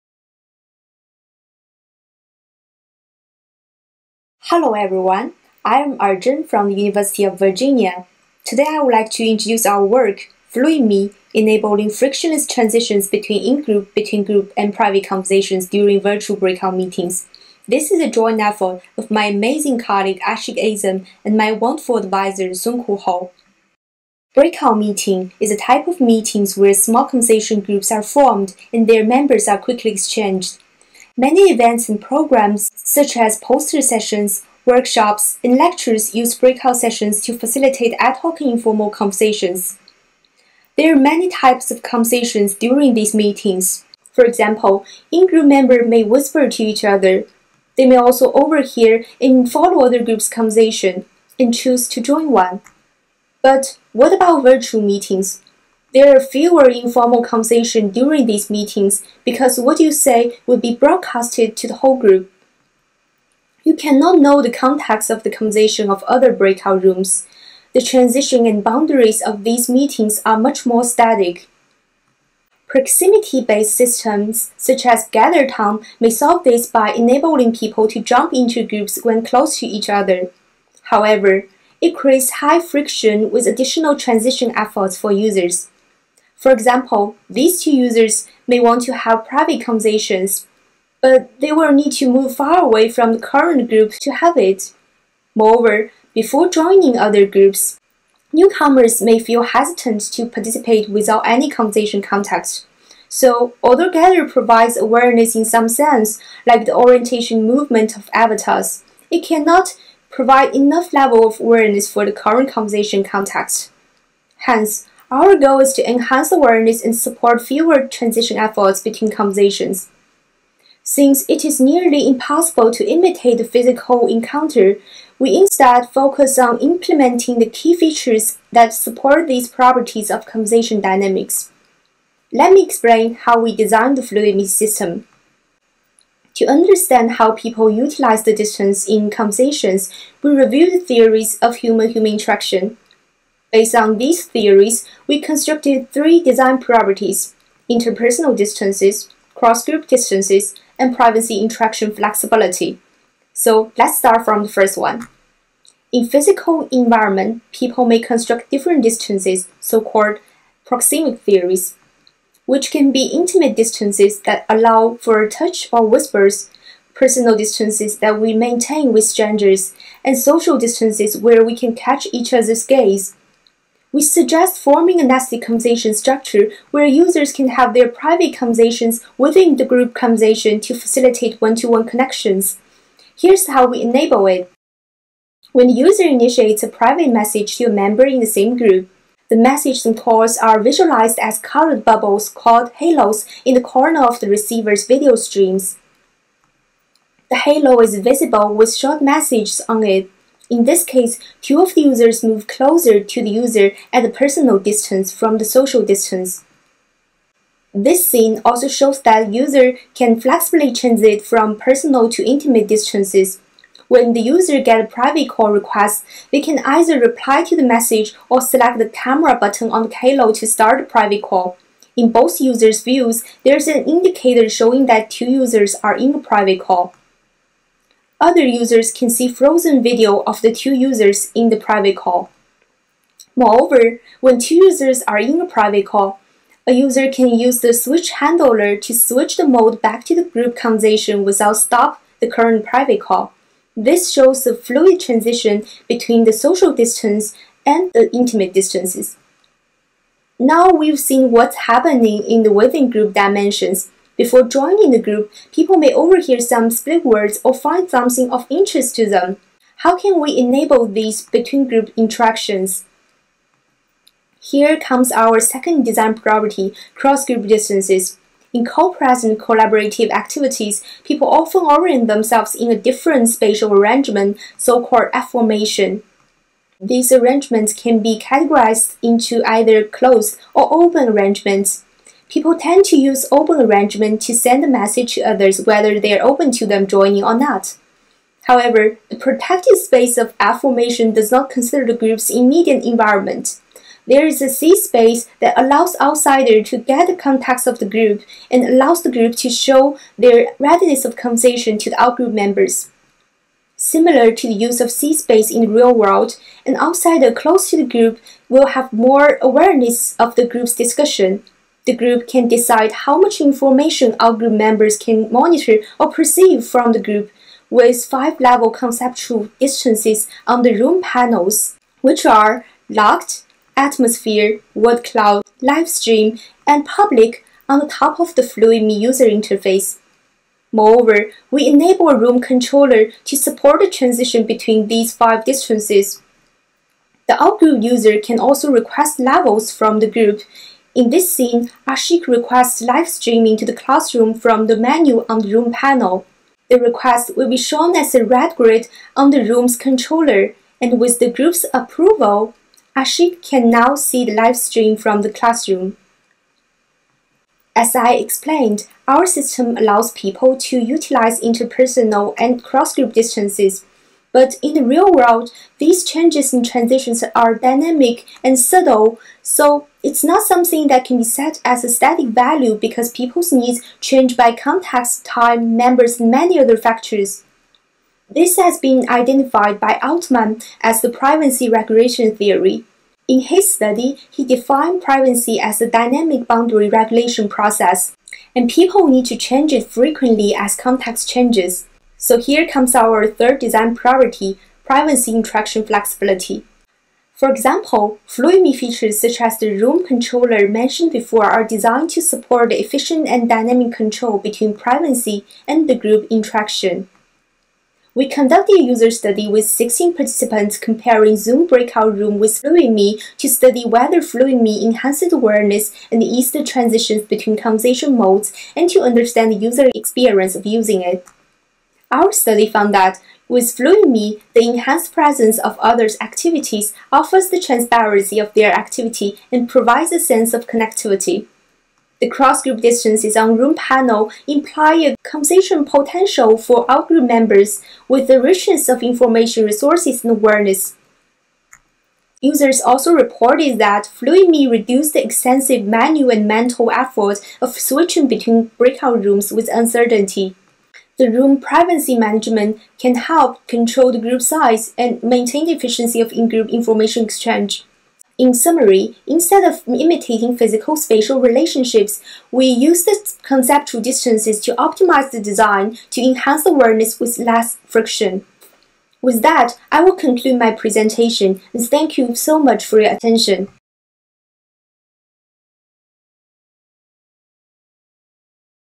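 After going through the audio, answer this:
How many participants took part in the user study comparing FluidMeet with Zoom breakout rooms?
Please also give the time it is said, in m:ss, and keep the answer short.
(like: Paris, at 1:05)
16, at 6:49.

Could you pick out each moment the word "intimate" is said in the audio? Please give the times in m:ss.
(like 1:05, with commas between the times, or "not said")
2:43, 3:32, 4:08.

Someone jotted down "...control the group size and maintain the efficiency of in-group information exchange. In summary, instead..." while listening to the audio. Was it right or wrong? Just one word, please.
right.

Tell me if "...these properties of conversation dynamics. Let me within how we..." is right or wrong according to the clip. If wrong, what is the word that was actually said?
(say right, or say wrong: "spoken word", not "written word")
wrong: "explain", not "within".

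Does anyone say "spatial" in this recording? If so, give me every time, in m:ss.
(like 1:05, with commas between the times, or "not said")
4:33, 7:40.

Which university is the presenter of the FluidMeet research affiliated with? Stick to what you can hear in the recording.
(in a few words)
University of Virginia.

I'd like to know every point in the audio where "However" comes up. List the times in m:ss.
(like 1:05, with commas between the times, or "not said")
1:20, 4:48.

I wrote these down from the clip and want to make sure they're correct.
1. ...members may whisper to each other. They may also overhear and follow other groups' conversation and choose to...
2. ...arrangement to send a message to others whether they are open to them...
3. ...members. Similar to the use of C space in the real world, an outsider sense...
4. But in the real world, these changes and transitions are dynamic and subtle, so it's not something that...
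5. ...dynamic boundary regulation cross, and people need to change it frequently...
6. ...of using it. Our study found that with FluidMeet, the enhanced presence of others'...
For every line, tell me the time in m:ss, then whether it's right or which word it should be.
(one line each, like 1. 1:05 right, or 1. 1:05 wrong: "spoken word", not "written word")
1. 0:45 right
2. 4:43 right
3. 5:02 wrong: "close", not "sense"
4. 6:04 right
5. 6:25 wrong: "process", not "cross"
6. 7:00 right.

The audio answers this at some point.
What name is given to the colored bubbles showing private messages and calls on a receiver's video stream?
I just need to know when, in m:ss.
3:12.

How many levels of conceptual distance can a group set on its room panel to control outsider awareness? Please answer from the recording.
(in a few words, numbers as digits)
5.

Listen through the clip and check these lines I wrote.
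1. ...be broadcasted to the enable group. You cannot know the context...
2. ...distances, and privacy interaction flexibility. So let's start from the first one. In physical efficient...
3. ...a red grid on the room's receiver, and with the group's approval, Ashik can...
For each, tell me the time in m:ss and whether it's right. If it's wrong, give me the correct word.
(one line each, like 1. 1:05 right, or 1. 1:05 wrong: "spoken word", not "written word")
1. 1:00 wrong: "whole", not "enable"
2. 2:29 wrong: "environment", not "efficient"
3. 5:48 wrong: "controller", not "receiver".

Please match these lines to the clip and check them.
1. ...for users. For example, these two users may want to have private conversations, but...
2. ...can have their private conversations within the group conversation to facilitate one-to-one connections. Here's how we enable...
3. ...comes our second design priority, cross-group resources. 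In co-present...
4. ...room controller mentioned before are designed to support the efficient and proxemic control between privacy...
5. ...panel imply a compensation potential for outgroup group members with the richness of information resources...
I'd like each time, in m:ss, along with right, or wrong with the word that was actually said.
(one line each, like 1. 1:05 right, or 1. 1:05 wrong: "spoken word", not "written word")
1. 1:24 right
2. 2:57 right
3. 4:24 wrong: "distances", not "resources"
4. 6:39 wrong: "dynamic", not "proxemic"
5. 7:13 right.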